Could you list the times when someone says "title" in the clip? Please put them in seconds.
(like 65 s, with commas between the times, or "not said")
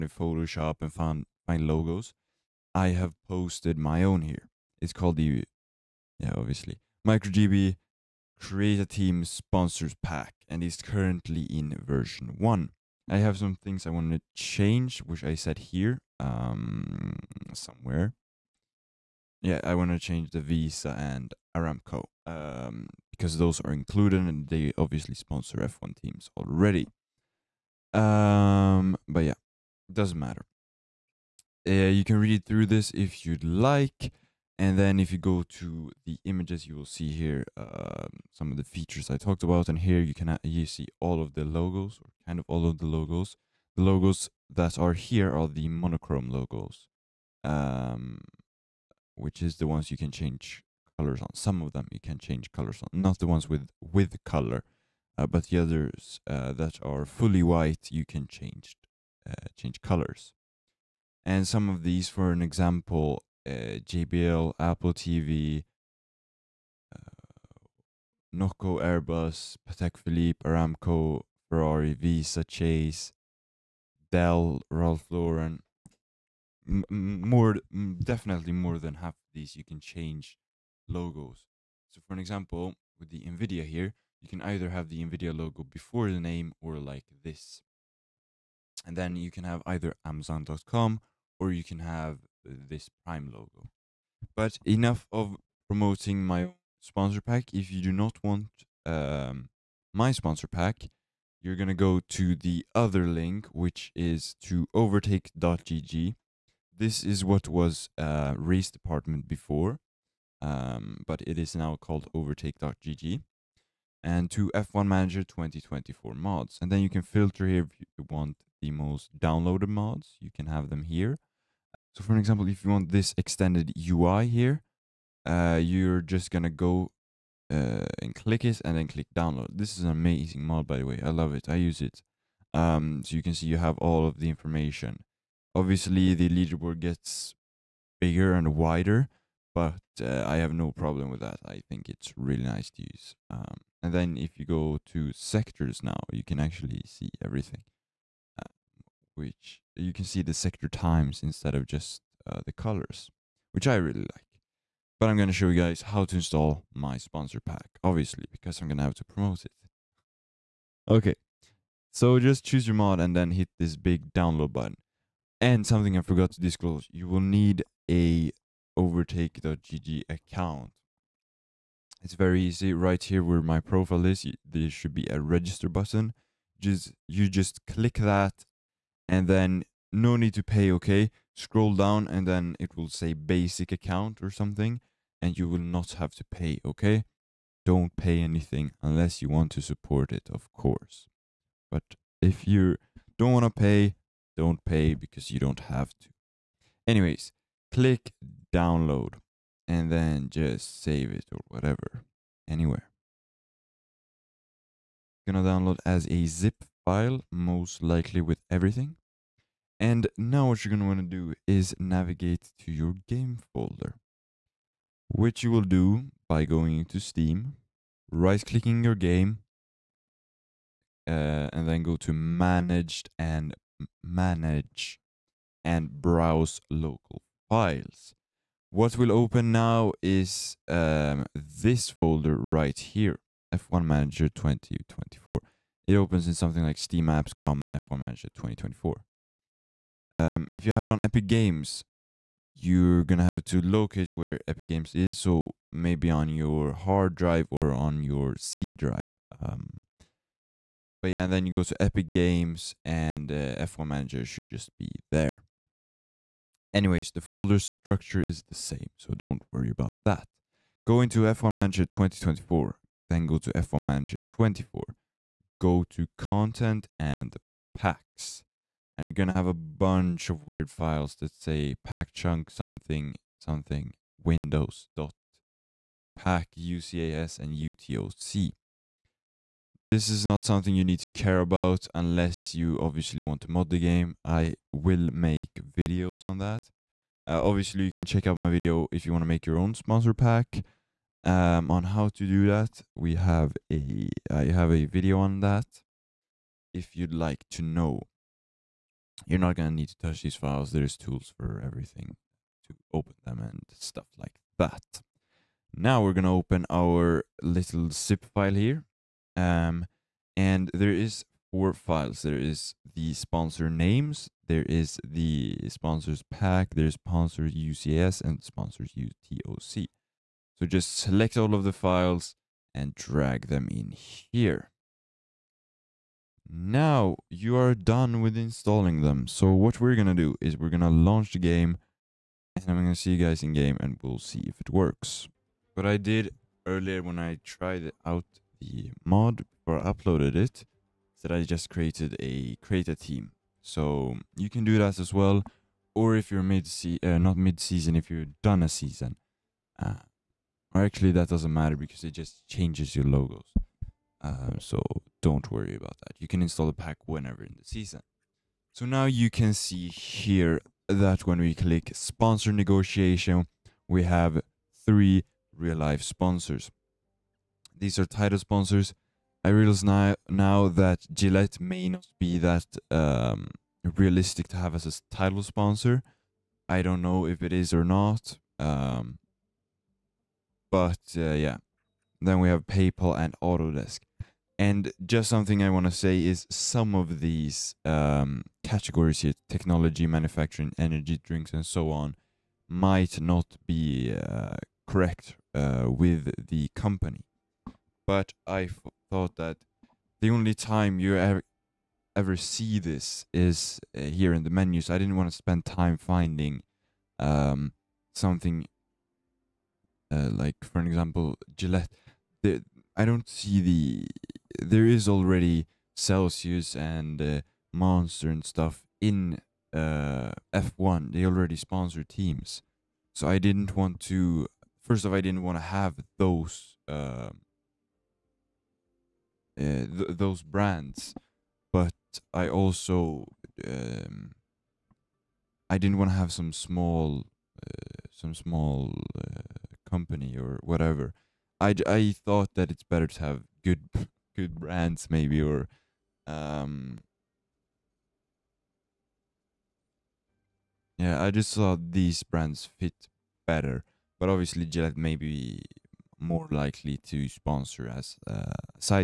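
368 s, 375 s.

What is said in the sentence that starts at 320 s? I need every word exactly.
So just select all of the files and drag them in here.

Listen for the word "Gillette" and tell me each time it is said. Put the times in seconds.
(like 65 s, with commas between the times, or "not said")
371 s, 411 s, 454 s.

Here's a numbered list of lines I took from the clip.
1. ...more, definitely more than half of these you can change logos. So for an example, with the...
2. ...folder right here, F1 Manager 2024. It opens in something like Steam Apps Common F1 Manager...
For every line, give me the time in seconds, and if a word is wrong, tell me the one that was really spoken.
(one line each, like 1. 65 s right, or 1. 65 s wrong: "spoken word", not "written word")
1. 77 s right
2. 231 s right.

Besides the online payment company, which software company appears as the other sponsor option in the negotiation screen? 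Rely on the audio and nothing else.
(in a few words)
Autodesk.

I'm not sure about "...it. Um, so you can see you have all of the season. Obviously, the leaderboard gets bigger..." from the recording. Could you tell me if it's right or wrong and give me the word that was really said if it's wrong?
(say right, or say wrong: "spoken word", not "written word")
wrong: "information", not "season".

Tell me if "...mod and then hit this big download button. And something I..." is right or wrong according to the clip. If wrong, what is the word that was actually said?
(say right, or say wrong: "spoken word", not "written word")
right.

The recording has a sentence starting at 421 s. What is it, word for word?
They already sponsor teams, so I didn't want to.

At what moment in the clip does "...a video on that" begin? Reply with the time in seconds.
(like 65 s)
294 s.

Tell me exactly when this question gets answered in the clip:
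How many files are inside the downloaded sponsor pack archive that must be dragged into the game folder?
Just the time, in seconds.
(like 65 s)
311 s.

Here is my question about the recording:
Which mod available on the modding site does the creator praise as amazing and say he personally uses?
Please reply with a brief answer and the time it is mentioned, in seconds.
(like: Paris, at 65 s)
Extended UI, at 123 s.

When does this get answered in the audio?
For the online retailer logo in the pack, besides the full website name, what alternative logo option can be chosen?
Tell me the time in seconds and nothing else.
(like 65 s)
93 s.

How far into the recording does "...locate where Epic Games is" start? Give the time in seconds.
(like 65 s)
243 s.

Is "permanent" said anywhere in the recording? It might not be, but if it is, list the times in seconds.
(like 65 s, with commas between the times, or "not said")
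not said.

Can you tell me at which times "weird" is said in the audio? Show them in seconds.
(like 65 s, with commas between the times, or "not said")
270 s.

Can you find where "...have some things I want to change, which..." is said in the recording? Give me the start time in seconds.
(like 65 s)
13 s.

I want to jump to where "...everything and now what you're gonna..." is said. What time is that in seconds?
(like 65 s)
208 s.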